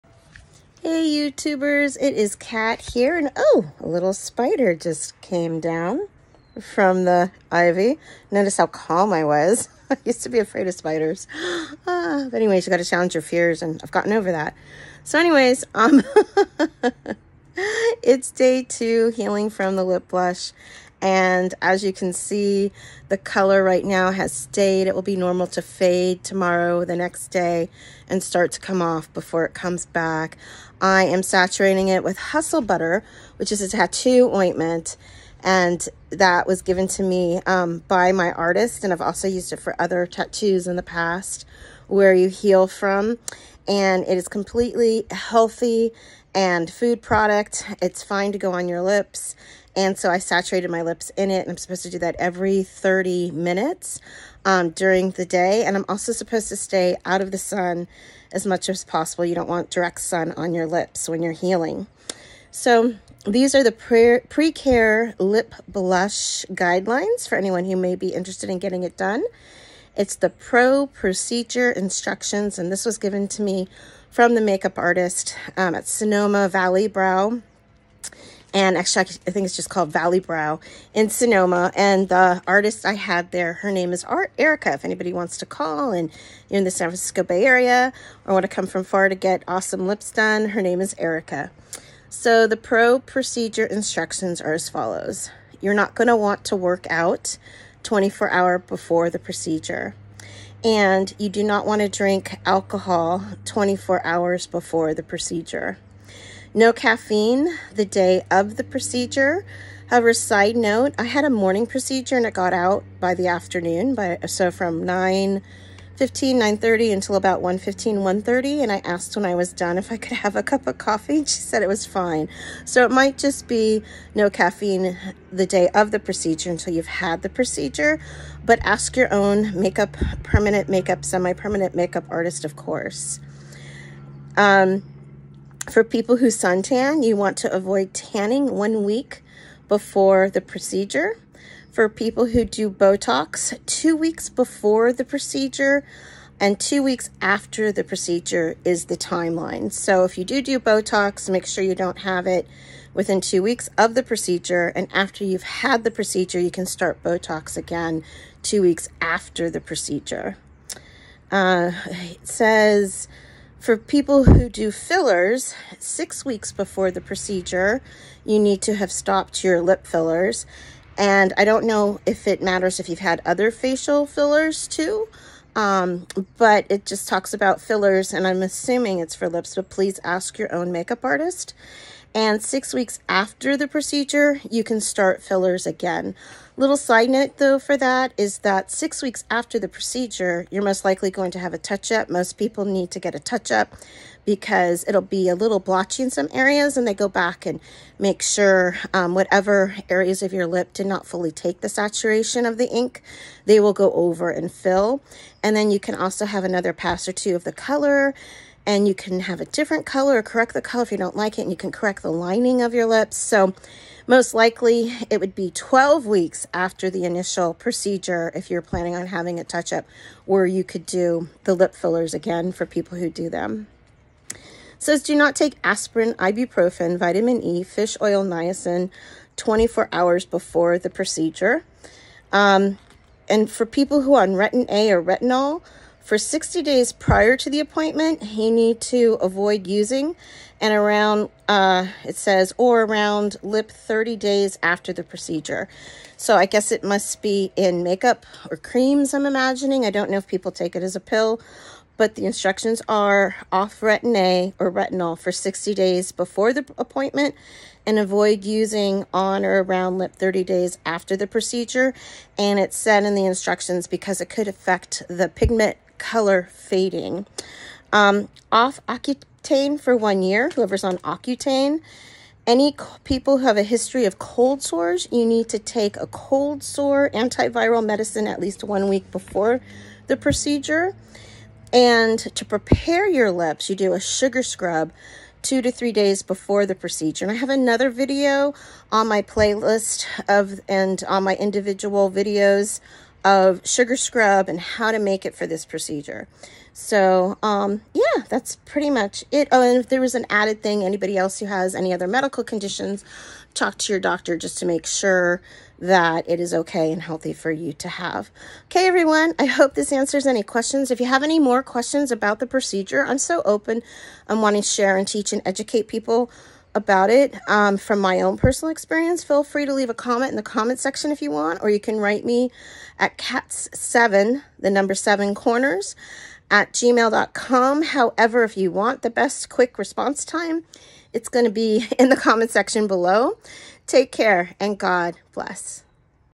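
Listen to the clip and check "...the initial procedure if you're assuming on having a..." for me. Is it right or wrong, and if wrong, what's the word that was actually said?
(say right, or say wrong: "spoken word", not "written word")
wrong: "planning", not "assuming".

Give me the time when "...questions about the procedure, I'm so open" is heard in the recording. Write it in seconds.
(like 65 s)
311 s.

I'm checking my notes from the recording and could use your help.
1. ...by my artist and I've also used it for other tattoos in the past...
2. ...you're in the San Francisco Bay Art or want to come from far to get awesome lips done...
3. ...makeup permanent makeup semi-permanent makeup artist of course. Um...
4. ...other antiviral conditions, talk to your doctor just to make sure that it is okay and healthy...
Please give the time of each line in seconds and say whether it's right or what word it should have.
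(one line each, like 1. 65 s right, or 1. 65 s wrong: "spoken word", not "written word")
1. 37 s right
2. 86 s wrong: "Area", not "Art"
3. 129 s right
4. 301 s wrong: "medical", not "antiviral".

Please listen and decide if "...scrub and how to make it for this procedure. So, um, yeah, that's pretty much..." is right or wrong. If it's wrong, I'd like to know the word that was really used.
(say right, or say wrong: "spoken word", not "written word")
right.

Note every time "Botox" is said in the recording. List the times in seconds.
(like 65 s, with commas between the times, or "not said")
142 s, 150 s, 157 s.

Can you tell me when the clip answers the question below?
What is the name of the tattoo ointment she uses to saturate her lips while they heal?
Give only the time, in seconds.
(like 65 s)
32 s.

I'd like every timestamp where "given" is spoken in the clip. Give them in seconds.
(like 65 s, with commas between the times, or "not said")
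36 s, 72 s.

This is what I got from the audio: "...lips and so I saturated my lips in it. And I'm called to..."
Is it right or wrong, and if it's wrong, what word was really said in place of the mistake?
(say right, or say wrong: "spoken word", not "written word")
wrong: "supposed", not "called".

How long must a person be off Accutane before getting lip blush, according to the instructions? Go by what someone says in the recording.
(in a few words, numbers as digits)
1 year.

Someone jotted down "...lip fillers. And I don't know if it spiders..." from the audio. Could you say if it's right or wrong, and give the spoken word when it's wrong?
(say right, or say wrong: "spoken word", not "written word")
wrong: "matters", not "spiders".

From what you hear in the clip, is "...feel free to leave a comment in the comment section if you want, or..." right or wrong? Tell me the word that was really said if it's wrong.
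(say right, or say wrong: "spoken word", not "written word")
right.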